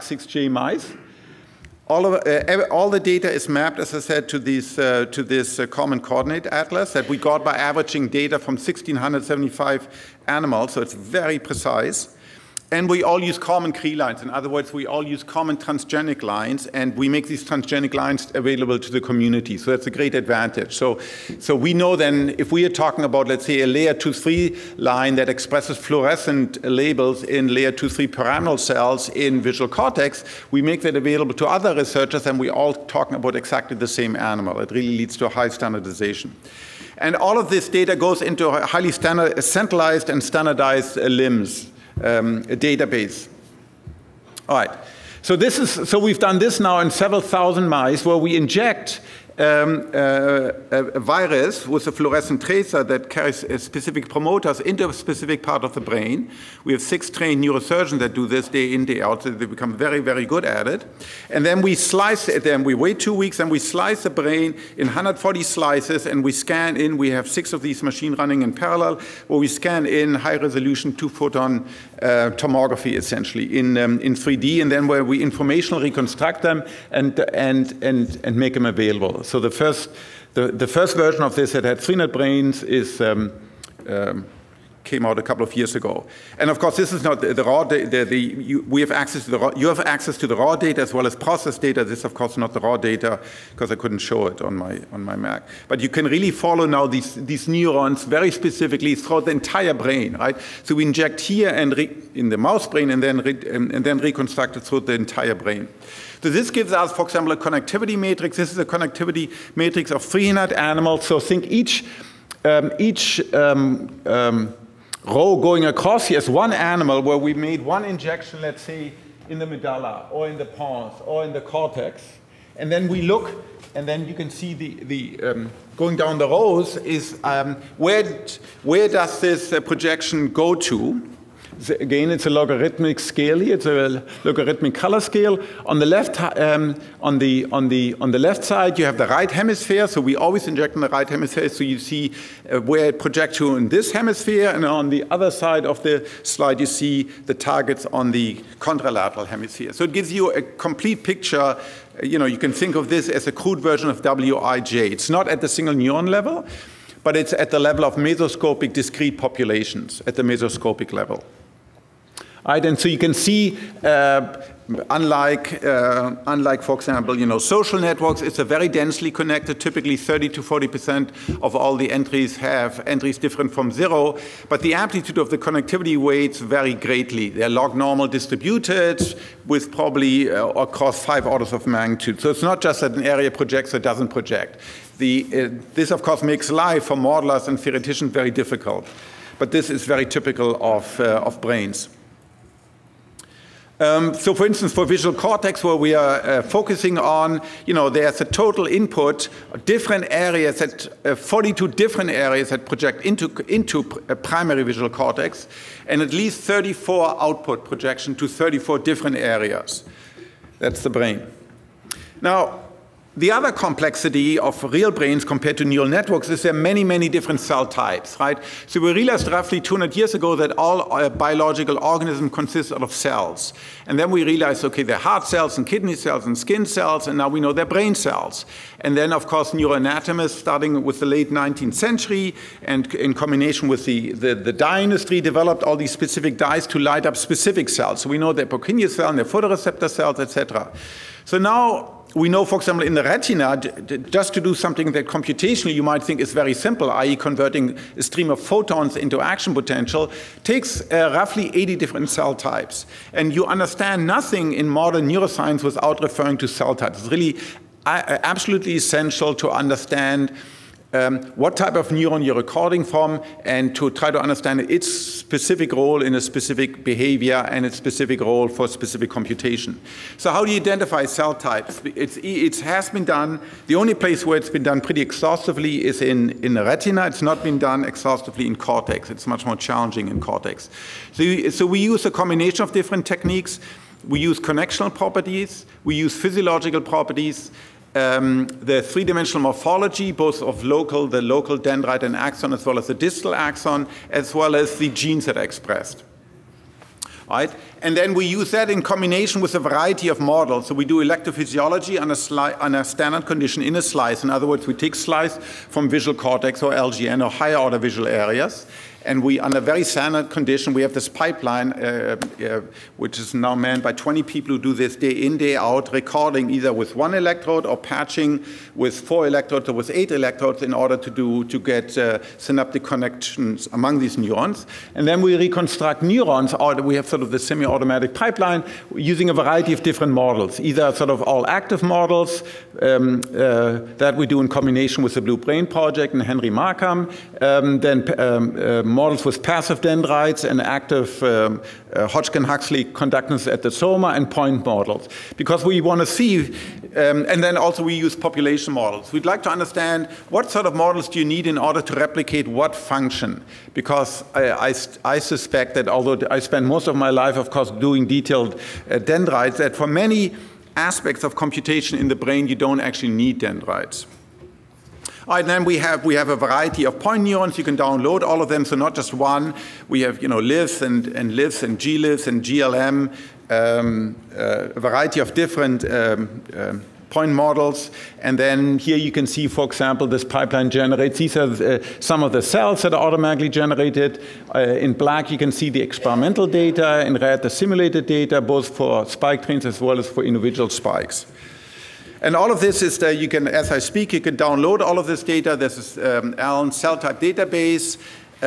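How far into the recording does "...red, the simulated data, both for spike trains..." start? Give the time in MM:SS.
06:27.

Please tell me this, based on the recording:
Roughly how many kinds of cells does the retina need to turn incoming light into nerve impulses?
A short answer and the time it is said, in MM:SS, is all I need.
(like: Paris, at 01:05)
80, at 04:11.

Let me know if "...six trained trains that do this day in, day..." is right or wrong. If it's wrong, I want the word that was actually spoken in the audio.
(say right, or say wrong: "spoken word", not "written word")
wrong: "neurosurgeons", not "trains".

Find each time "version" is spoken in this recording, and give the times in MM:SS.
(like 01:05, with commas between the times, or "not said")
01:20, 02:33.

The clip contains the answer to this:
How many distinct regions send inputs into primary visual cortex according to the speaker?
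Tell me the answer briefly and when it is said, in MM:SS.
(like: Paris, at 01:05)
42, at 03:21.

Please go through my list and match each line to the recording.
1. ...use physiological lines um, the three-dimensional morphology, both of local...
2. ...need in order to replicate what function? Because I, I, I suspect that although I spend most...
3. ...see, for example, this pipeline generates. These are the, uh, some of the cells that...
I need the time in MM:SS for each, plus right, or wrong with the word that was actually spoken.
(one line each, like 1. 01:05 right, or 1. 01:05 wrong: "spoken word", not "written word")
1. 04:45 wrong: "properties", not "lines"
2. 05:51 right
3. 06:19 right.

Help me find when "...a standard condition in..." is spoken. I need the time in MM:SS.
05:02.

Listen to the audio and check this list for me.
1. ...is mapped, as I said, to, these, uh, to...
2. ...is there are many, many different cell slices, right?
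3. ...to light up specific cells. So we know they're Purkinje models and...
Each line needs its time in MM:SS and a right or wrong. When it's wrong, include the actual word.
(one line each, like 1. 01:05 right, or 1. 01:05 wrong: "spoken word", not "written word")
1. 00:03 right
2. 03:36 wrong: "types", not "slices"
3. 03:56 wrong: "cells", not "models".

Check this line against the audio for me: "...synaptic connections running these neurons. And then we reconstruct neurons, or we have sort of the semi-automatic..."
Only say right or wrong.
wrong.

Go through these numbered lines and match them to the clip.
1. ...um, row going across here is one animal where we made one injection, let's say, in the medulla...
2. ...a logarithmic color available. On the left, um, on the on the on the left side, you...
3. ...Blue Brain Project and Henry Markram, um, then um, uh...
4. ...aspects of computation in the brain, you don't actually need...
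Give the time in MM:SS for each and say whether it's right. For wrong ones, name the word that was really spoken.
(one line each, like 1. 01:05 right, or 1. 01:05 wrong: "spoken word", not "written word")
1. 01:54 right
2. 02:13 wrong: "scale", not "available"
3. 05:35 right
4. 06:00 right.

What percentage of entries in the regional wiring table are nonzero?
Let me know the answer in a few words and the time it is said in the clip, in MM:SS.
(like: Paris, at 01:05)
30 to 40 percent, at 02:49.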